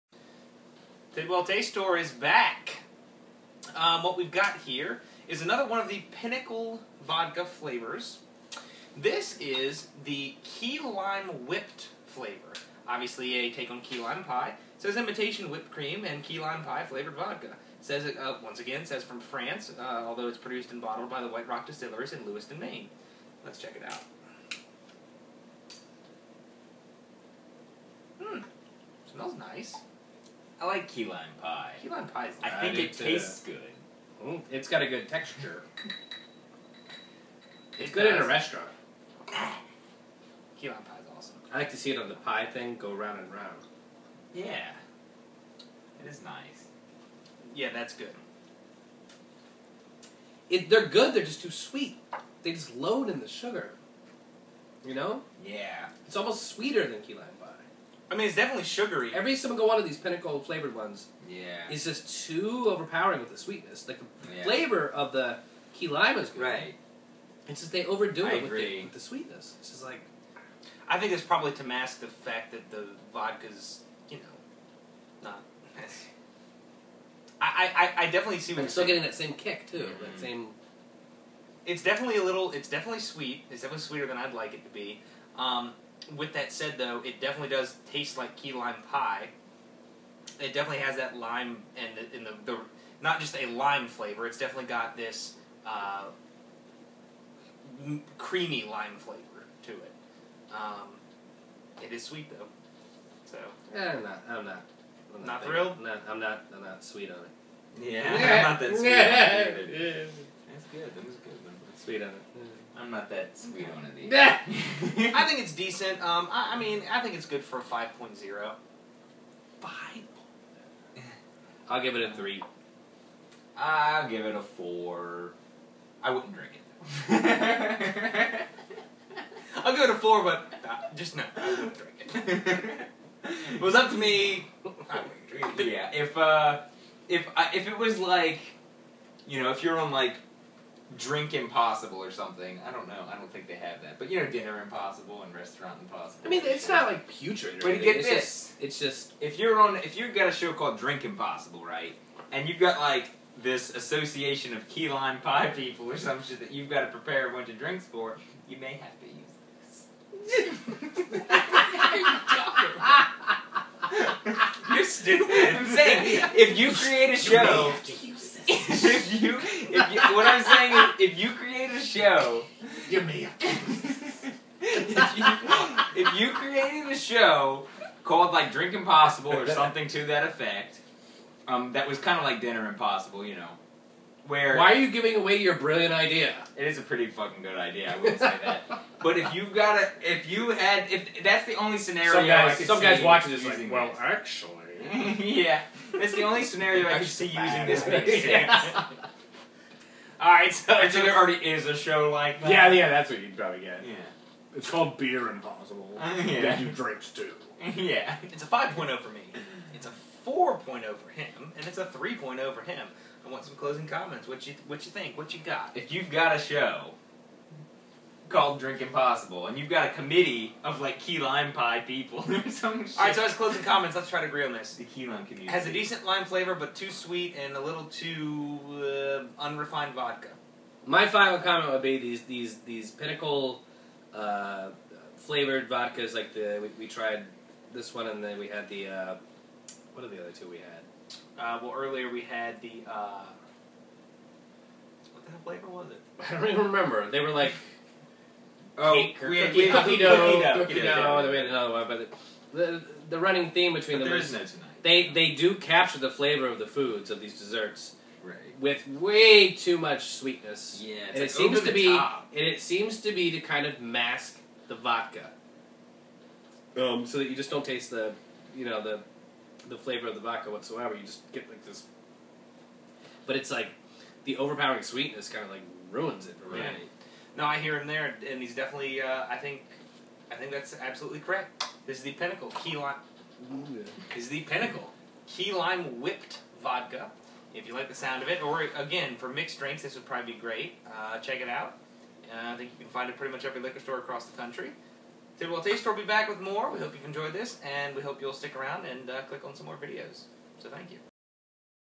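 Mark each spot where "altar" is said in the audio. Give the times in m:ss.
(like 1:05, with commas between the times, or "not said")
not said.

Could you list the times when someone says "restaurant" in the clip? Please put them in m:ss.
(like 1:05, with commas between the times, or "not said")
0:38, 2:25.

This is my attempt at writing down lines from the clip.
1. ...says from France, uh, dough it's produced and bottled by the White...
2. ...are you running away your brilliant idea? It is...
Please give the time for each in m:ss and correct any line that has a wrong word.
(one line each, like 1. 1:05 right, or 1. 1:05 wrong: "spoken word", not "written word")
1. 0:18 wrong: "although", not "dough"
2. 3:04 wrong: "giving", not "running".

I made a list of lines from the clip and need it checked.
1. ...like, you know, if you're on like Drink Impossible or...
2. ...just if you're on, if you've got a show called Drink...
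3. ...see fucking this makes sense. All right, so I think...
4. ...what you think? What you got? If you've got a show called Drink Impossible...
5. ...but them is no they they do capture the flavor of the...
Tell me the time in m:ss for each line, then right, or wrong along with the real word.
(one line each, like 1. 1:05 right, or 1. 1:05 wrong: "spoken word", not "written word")
1. 2:17 right
2. 2:28 right
3. 3:17 wrong: "using", not "fucking"
4. 3:34 right
5. 4:13 right.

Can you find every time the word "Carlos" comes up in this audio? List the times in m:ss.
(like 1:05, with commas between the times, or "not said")
not said.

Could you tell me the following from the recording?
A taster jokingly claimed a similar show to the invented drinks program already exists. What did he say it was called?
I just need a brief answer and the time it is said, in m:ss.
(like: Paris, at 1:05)
Beer Impossible, at 3:24.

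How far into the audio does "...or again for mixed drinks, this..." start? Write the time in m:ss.
4:48.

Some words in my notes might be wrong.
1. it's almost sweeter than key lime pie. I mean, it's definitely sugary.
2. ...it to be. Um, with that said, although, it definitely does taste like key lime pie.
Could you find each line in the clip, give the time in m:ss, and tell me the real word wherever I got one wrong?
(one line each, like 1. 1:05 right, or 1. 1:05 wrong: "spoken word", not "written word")
1. 0:56 right
2. 1:24 wrong: "though", not "although".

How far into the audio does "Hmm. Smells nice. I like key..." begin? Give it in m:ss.
0:28.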